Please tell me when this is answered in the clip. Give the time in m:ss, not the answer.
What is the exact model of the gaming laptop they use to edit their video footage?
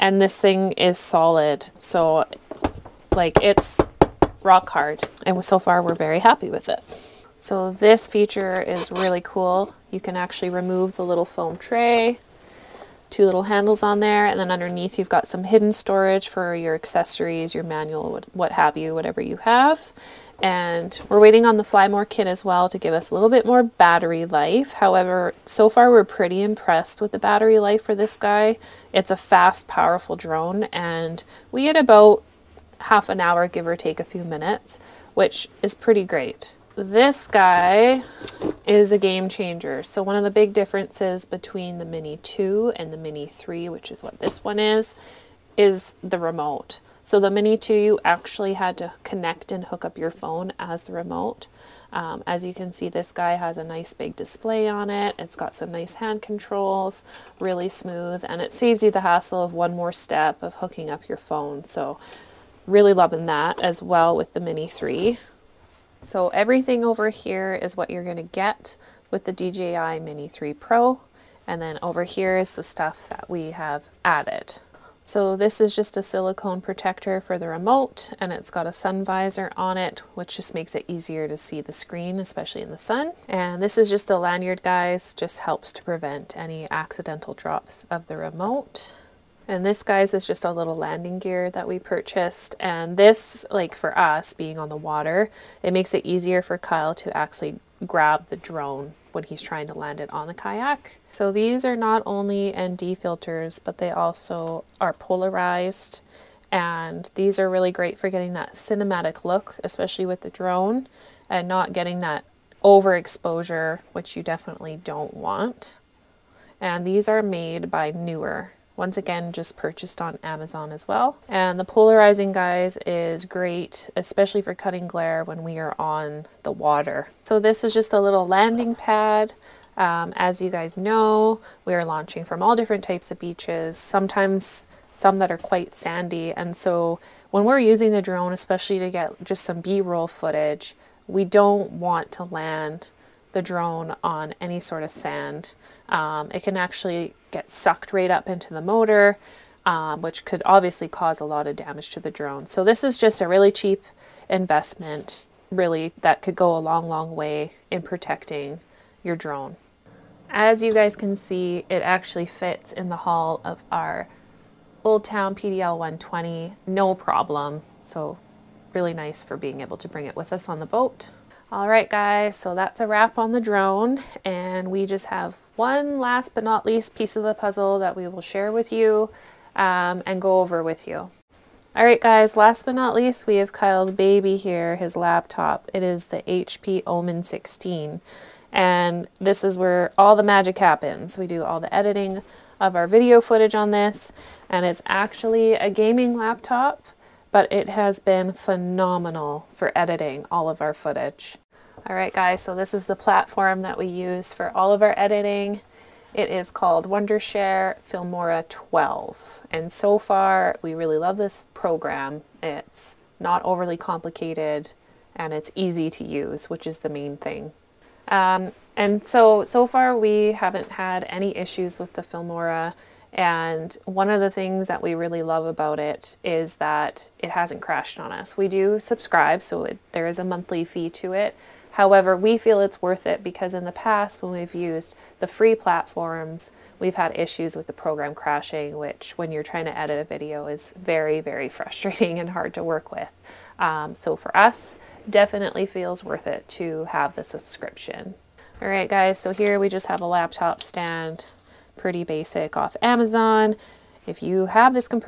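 3:06.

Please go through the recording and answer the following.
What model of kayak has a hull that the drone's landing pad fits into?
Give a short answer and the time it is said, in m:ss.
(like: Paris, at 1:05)
Old Town PDL 120, at 2:44.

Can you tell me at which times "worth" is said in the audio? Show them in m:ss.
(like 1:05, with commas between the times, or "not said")
3:52, 4:06.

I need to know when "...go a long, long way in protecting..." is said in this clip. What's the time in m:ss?
2:36.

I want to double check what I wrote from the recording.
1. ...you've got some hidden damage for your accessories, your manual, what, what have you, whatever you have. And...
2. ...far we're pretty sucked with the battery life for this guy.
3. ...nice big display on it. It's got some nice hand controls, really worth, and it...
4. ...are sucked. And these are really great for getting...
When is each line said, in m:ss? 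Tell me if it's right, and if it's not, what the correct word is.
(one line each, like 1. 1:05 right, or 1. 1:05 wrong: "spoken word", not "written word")
1. 0:14 wrong: "storage", not "damage"
2. 0:25 wrong: "impressed", not "sucked"
3. 0:53 wrong: "smooth", not "worth"
4. 1:44 wrong: "polarized", not "sucked".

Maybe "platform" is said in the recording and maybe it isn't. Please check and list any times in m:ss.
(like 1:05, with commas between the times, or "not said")
3:22, 3:55.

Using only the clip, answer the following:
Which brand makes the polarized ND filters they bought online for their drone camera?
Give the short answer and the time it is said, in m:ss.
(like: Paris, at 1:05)
Neewer, at 1:57.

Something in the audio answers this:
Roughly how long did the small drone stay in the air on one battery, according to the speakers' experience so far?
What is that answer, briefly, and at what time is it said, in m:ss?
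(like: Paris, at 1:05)
half an hour, at 0:32.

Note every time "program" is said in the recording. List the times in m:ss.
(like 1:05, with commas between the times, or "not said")
3:31, 3:57.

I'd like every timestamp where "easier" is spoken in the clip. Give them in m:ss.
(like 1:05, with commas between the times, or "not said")
1:20, 1:36.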